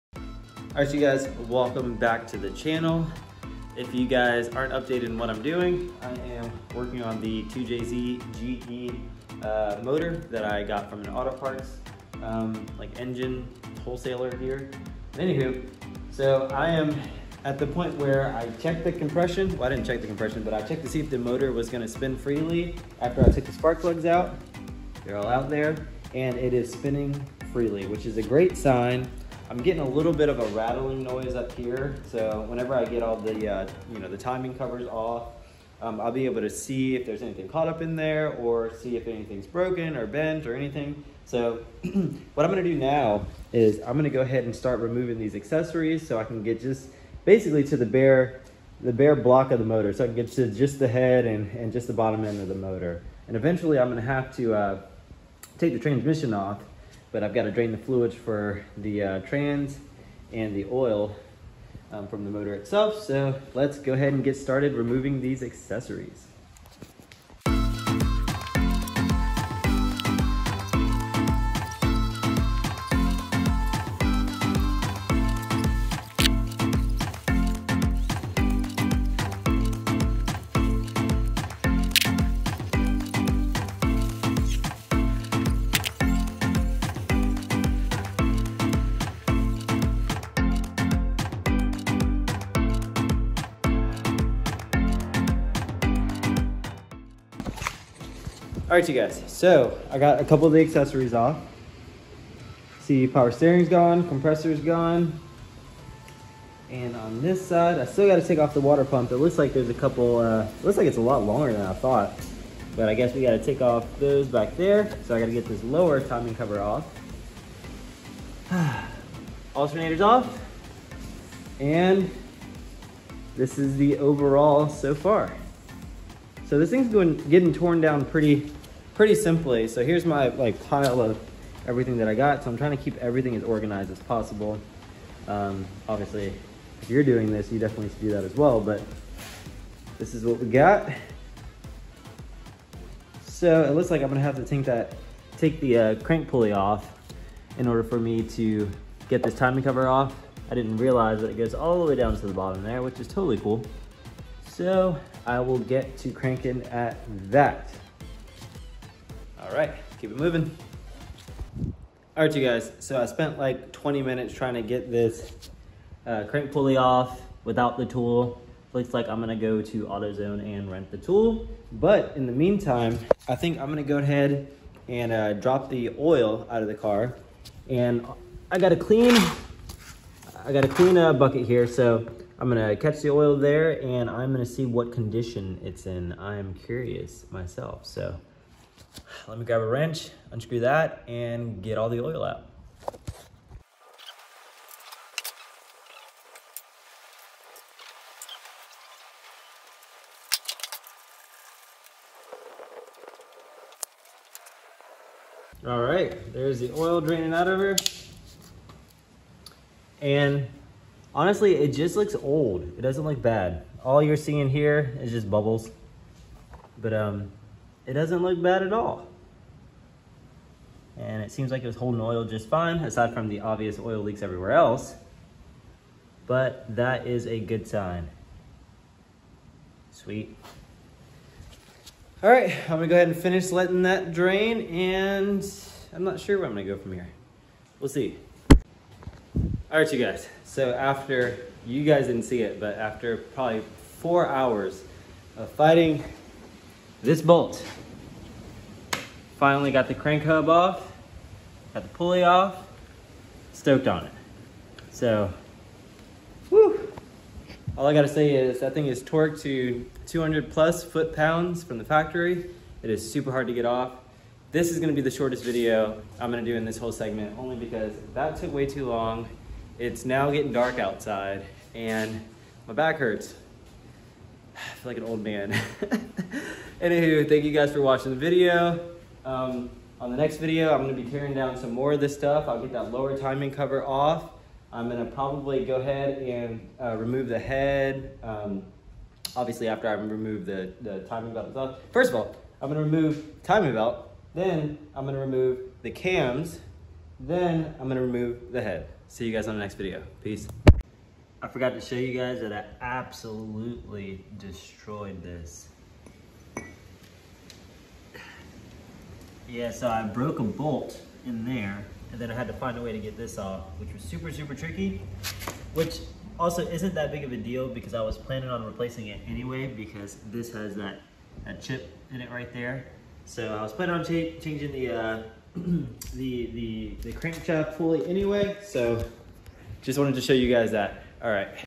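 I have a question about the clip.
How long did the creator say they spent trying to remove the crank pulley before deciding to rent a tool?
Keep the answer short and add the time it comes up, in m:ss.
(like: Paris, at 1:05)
20 minutes, at 2:43.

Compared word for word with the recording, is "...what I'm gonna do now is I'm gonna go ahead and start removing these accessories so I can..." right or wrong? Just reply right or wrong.
right.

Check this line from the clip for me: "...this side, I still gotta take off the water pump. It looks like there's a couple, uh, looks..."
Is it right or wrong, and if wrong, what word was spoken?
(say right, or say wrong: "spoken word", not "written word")
right.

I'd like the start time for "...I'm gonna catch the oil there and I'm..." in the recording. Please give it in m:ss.
3:02.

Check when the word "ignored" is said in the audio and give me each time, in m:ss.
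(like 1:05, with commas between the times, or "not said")
not said.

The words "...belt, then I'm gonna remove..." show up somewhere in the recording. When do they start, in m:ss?
4:53.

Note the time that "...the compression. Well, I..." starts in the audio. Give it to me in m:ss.
0:18.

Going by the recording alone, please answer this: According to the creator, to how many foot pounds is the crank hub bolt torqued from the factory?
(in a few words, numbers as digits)
200 plus.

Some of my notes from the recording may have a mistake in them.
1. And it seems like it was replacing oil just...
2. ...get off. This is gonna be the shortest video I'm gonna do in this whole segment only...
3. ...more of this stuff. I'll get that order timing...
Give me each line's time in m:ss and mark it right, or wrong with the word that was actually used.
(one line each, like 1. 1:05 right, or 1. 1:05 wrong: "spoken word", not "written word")
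1. 3:40 wrong: "holding", not "replacing"
2. 4:23 right
3. 4:41 wrong: "lower", not "order".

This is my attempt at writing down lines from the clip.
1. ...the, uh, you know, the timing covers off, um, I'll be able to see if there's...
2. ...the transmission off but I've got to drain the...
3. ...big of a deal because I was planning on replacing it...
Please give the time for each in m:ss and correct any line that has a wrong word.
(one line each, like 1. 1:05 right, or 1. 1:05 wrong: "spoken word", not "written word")
1. 0:33 right
2. 0:55 right
3. 5:17 right.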